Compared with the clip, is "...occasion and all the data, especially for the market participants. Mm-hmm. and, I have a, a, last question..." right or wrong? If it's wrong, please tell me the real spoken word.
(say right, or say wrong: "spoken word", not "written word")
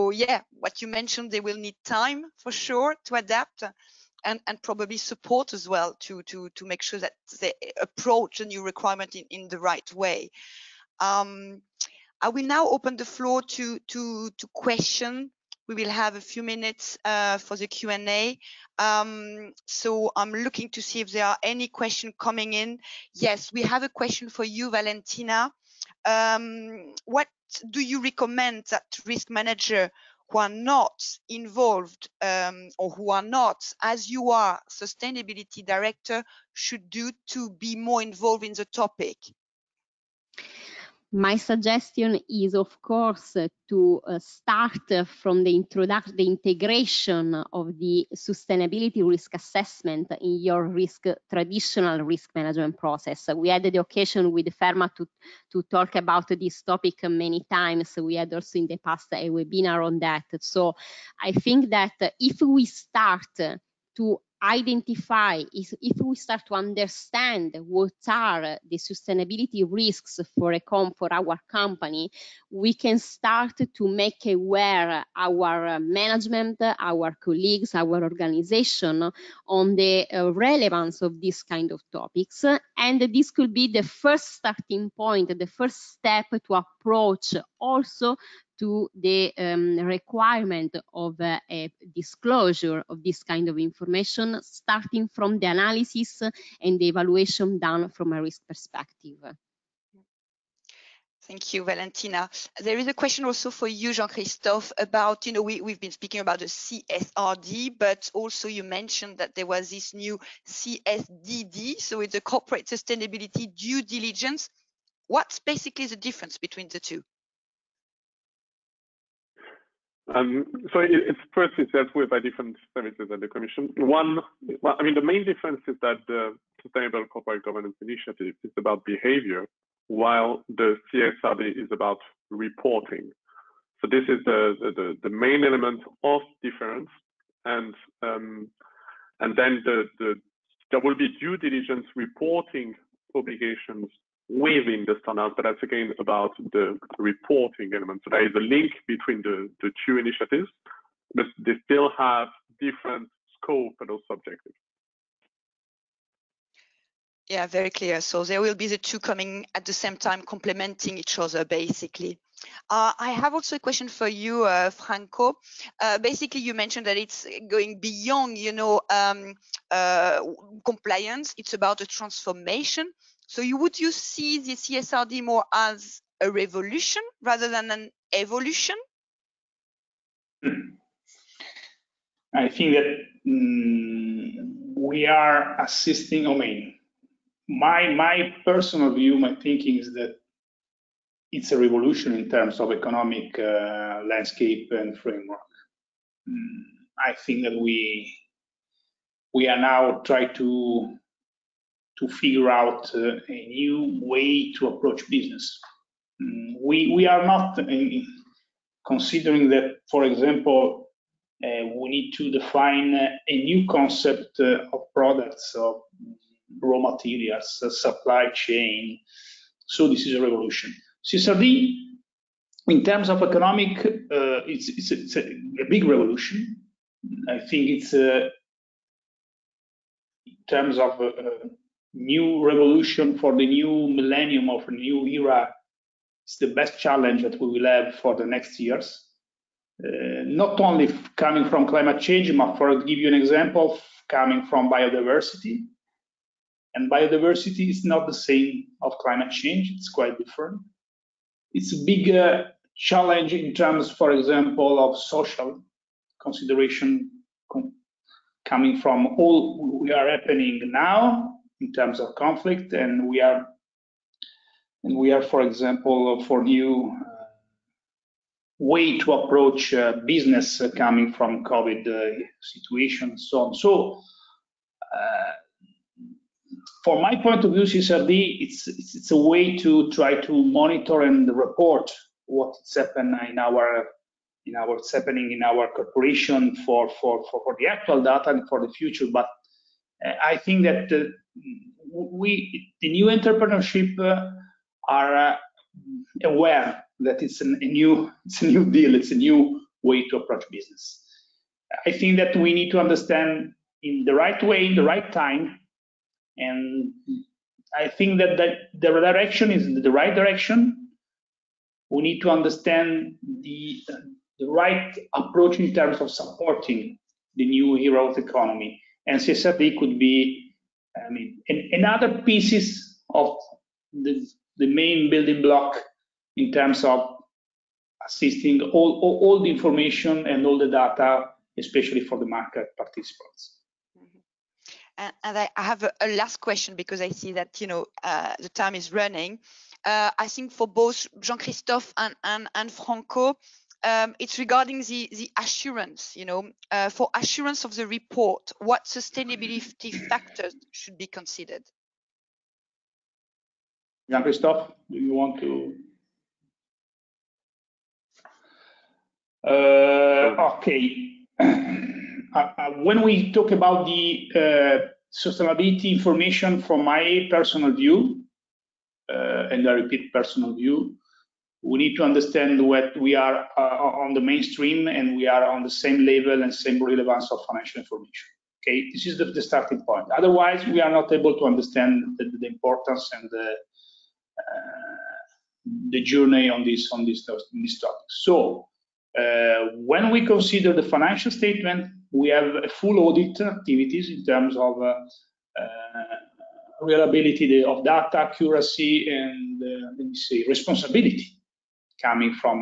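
wrong: "information", not "occasion".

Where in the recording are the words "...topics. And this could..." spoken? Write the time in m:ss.
1:21.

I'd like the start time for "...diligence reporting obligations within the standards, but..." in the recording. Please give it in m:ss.
2:21.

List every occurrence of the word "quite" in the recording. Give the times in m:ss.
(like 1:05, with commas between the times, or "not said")
4:09.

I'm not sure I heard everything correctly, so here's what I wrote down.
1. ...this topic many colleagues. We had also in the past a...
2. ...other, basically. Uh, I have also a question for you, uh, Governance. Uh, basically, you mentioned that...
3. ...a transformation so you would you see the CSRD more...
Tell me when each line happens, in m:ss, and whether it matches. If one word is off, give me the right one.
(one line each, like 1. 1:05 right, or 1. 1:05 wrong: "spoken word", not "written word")
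1. 0:56 wrong: "times", not "colleagues"
2. 2:41 wrong: "Franco", not "Governance"
3. 2:51 right.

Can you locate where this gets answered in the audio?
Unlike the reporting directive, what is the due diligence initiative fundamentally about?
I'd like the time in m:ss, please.
2:08.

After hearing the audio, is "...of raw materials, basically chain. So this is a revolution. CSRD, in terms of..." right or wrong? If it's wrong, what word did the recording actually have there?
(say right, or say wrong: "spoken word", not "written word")
wrong: "supply", not "basically".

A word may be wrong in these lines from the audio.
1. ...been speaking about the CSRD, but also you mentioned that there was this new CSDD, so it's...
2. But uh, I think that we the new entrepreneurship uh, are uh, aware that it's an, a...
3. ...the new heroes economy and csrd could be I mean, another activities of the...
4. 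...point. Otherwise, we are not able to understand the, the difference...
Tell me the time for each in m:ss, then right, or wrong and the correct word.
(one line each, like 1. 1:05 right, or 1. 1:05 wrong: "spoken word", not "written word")
1. 1:45 right
2. 4:49 right
3. 5:17 wrong: "pieces", not "activities"
4. 6:19 wrong: "importance", not "difference".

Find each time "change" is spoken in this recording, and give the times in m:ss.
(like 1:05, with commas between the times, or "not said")
4:01, 4:09.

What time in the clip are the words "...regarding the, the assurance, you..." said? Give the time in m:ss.
5:44.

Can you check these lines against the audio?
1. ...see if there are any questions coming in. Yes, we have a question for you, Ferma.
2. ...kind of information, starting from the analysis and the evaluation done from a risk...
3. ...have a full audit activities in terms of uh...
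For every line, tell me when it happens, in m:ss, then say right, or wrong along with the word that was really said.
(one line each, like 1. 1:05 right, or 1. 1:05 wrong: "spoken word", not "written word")
1. 0:20 wrong: "Valentina", not "Ferma"
2. 1:33 right
3. 6:32 right.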